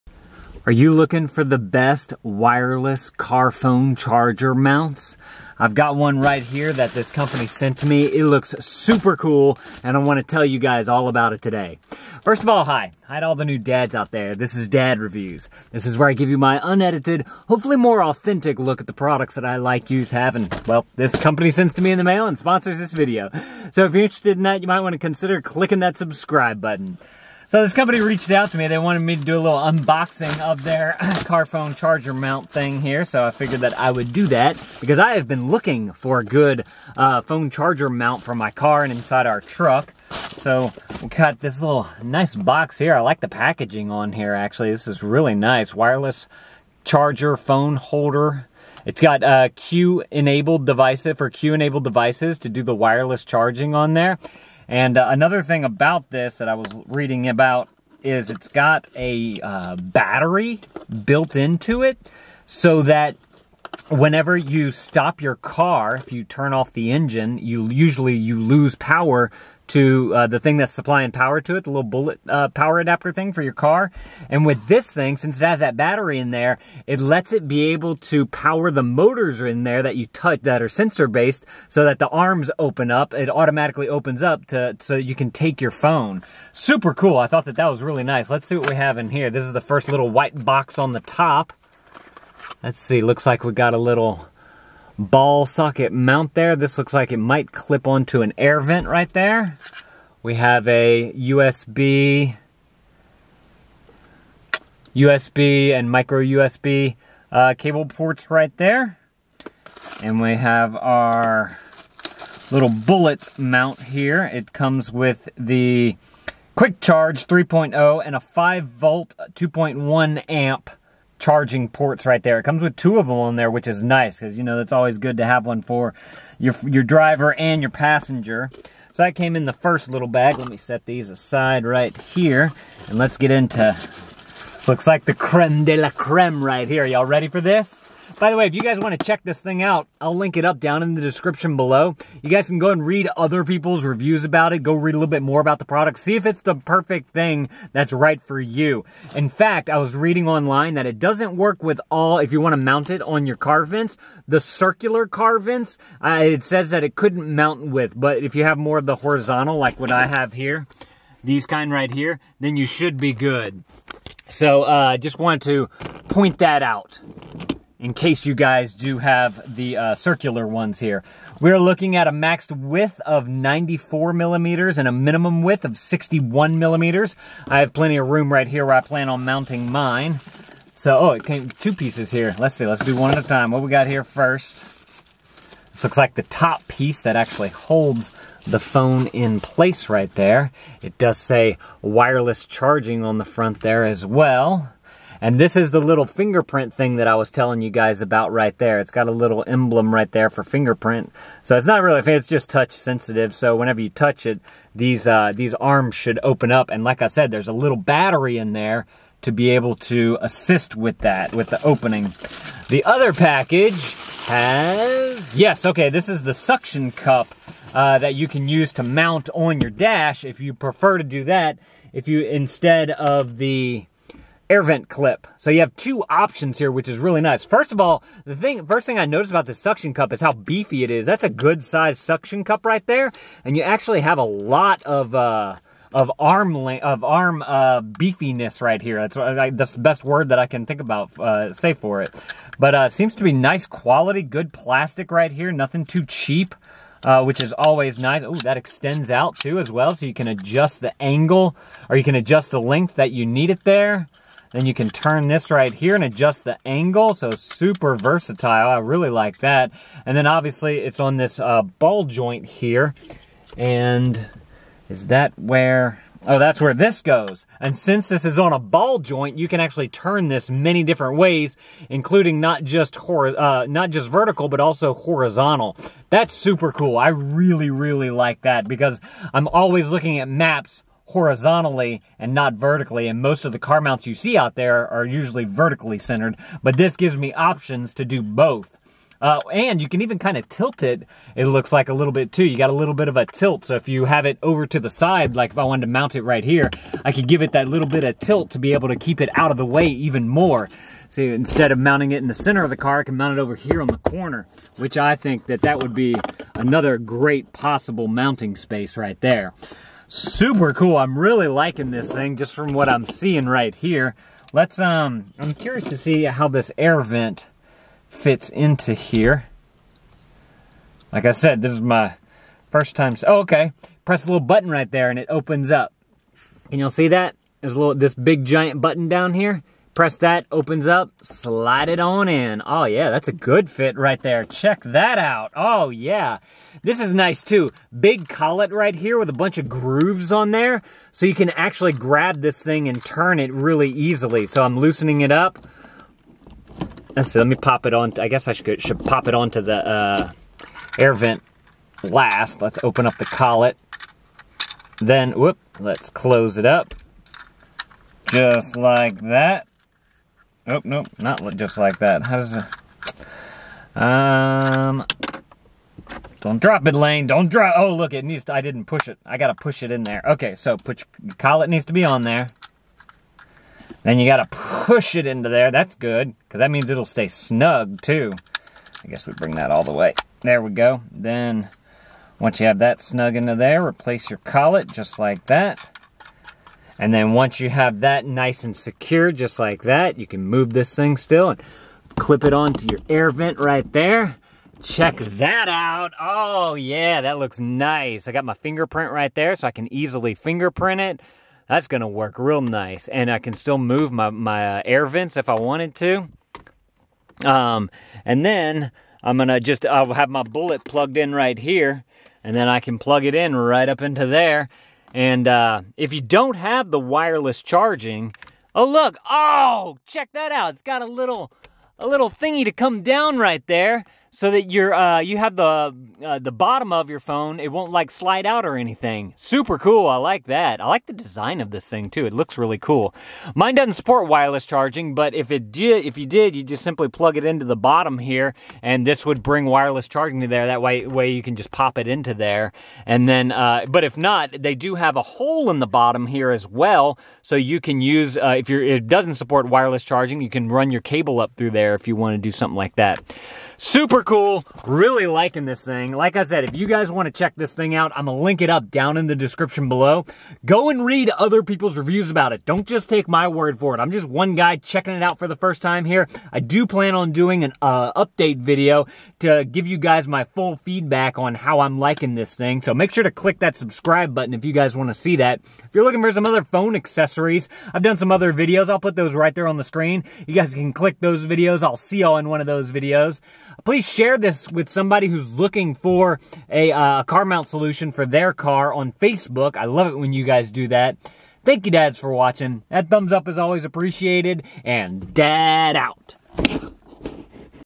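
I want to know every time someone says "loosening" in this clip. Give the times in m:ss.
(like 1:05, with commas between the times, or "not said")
5:44.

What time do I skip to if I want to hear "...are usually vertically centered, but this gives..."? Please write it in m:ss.
4:44.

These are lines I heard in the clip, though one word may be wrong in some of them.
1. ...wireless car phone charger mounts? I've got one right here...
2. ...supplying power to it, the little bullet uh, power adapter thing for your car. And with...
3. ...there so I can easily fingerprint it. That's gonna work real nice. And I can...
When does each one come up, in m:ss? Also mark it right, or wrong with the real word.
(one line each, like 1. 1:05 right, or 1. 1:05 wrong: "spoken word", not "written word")
1. 0:02 right
2. 1:10 right
3. 6:39 right.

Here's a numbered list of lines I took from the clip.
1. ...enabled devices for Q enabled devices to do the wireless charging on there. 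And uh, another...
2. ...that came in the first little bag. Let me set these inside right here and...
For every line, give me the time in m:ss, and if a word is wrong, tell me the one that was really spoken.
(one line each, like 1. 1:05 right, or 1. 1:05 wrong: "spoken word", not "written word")
1. 0:50 right
2. 2:09 wrong: "aside", not "inside".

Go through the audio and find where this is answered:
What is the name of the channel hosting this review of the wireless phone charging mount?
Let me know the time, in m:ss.
0:14.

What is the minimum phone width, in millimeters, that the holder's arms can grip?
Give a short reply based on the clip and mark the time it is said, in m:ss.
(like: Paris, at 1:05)
61 millimeters, at 2:55.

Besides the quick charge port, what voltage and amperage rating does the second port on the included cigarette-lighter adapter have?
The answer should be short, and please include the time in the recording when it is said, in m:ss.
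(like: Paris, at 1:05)
5 volt 2.1 amp, at 1:58.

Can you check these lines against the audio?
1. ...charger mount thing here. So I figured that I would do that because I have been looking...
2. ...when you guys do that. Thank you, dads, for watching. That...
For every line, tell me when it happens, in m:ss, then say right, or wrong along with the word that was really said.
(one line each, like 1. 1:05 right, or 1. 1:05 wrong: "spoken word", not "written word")
1. 0:31 right
2. 8:10 right.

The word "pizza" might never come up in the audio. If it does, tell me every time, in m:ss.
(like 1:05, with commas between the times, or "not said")
not said.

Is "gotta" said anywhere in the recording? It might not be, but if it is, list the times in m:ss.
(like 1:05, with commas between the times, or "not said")
6:09, 6:14.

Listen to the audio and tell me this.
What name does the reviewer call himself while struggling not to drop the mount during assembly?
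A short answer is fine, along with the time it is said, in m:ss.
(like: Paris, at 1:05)
Lane, at 6:06.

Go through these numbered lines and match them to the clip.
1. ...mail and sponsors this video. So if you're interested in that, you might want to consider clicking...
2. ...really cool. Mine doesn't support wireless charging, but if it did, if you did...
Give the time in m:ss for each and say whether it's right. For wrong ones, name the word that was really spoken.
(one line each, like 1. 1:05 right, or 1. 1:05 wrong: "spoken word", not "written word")
1. 0:22 right
2. 7:12 right.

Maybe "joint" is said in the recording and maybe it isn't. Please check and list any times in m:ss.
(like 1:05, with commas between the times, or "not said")
4:22, 4:28.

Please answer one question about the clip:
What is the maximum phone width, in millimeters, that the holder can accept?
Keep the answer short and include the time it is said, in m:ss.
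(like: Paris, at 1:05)
94 millimeters, at 2:53.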